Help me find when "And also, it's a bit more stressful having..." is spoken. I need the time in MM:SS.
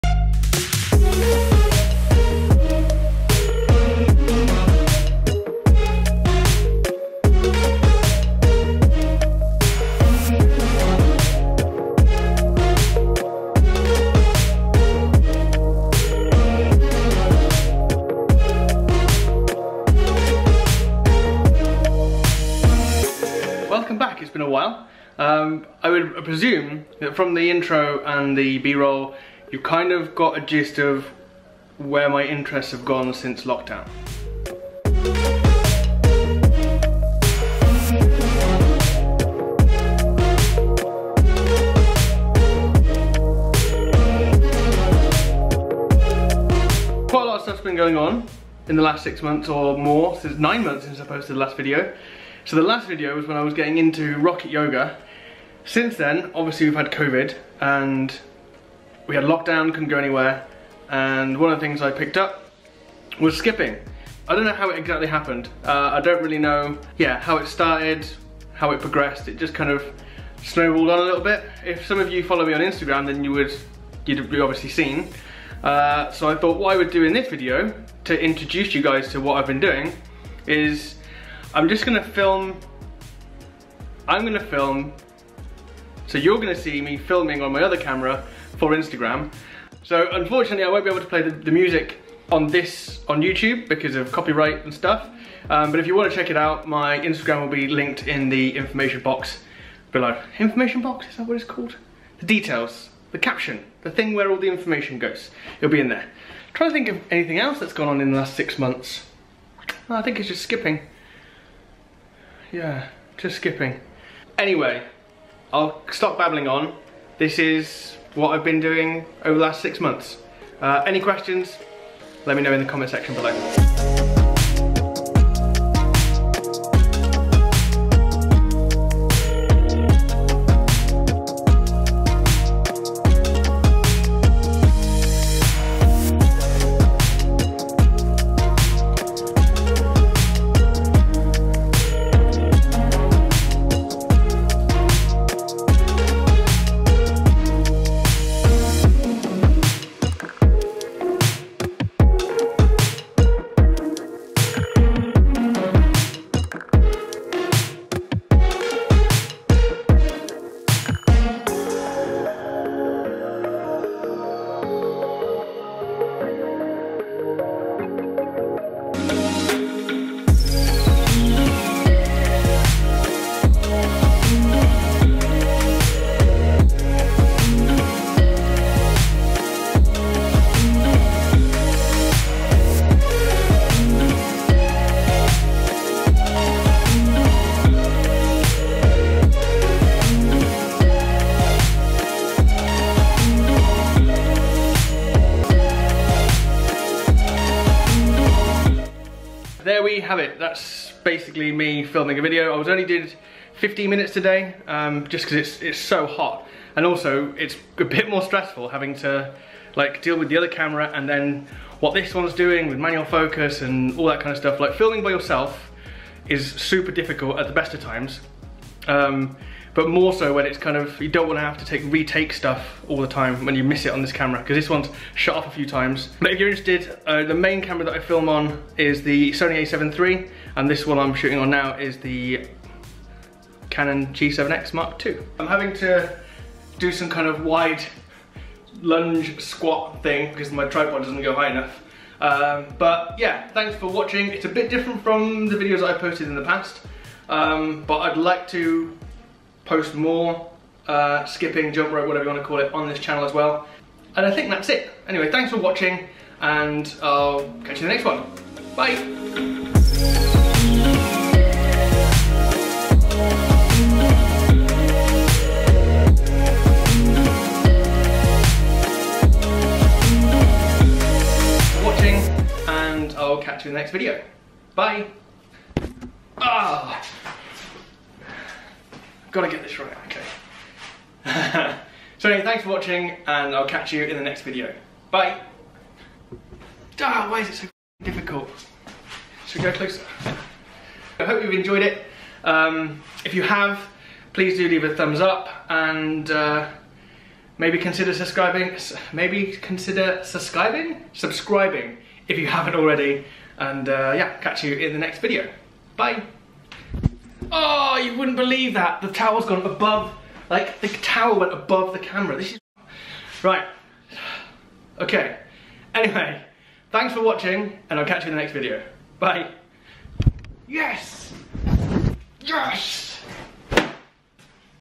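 03:26.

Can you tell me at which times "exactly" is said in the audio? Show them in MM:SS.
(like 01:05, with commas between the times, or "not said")
01:04.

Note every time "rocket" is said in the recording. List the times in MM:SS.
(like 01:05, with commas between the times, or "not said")
00:54.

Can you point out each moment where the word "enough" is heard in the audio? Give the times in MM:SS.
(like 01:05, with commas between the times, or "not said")
04:01.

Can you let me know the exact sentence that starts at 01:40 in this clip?
Information box, is that what it's called?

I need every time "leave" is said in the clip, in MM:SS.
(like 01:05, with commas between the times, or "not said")
04:54.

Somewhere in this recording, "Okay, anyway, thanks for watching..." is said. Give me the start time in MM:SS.
05:14.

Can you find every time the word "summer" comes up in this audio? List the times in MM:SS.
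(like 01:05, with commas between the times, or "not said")
not said.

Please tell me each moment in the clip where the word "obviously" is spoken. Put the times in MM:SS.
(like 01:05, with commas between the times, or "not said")
00:56, 01:14.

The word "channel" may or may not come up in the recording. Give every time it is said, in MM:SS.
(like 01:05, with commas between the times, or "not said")
04:12.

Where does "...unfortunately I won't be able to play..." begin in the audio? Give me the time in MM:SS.
01:30.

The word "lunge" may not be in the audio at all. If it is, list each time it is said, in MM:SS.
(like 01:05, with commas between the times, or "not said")
03:58.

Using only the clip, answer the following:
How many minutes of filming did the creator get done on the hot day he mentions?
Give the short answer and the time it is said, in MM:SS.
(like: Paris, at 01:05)
15, at 03:23.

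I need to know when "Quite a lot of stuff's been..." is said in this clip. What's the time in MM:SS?
00:47.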